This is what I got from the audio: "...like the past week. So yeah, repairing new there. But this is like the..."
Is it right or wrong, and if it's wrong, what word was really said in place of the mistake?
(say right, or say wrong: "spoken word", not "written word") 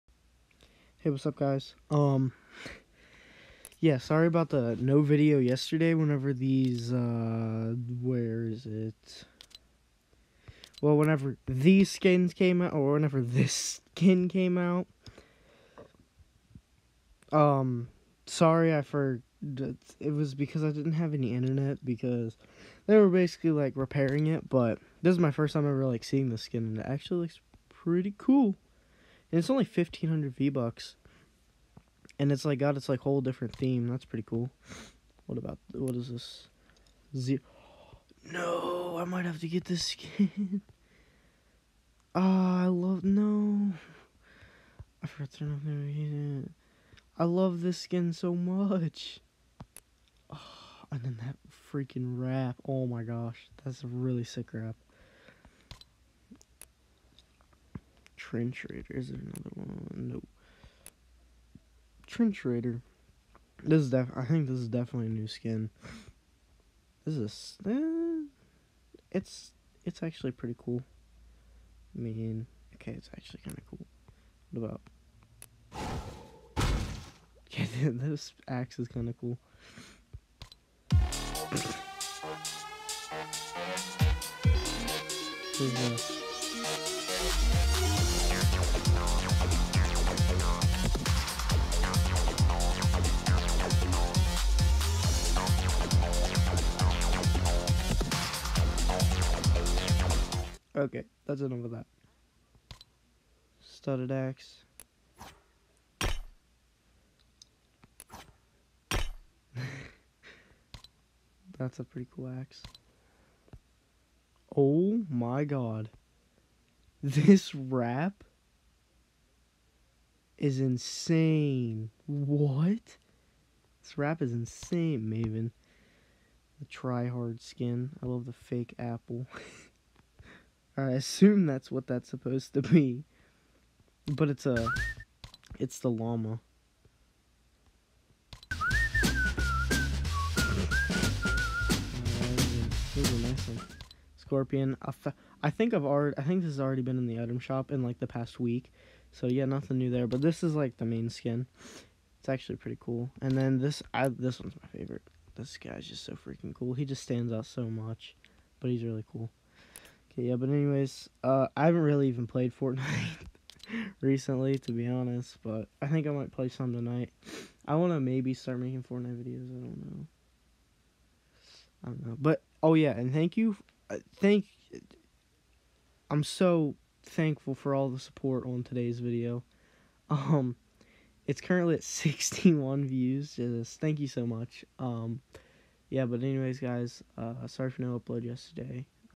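wrong: "nothing", not "repairing".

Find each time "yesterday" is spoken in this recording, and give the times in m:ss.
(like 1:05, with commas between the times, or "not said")
0:05, 3:08.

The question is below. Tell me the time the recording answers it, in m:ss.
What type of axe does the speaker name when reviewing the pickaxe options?
1:43.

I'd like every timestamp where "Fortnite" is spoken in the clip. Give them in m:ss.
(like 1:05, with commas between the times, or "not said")
2:42, 2:48.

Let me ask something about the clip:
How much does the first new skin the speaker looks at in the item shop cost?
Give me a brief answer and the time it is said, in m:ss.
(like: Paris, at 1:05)
1500 V-Bucks, at 0:29.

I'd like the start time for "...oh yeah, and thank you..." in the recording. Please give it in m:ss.
2:52.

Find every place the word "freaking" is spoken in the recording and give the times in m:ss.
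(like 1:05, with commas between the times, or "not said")
0:51, 2:36.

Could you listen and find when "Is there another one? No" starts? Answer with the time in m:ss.
0:58.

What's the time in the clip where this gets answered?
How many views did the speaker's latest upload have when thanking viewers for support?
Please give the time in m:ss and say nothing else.
3:01.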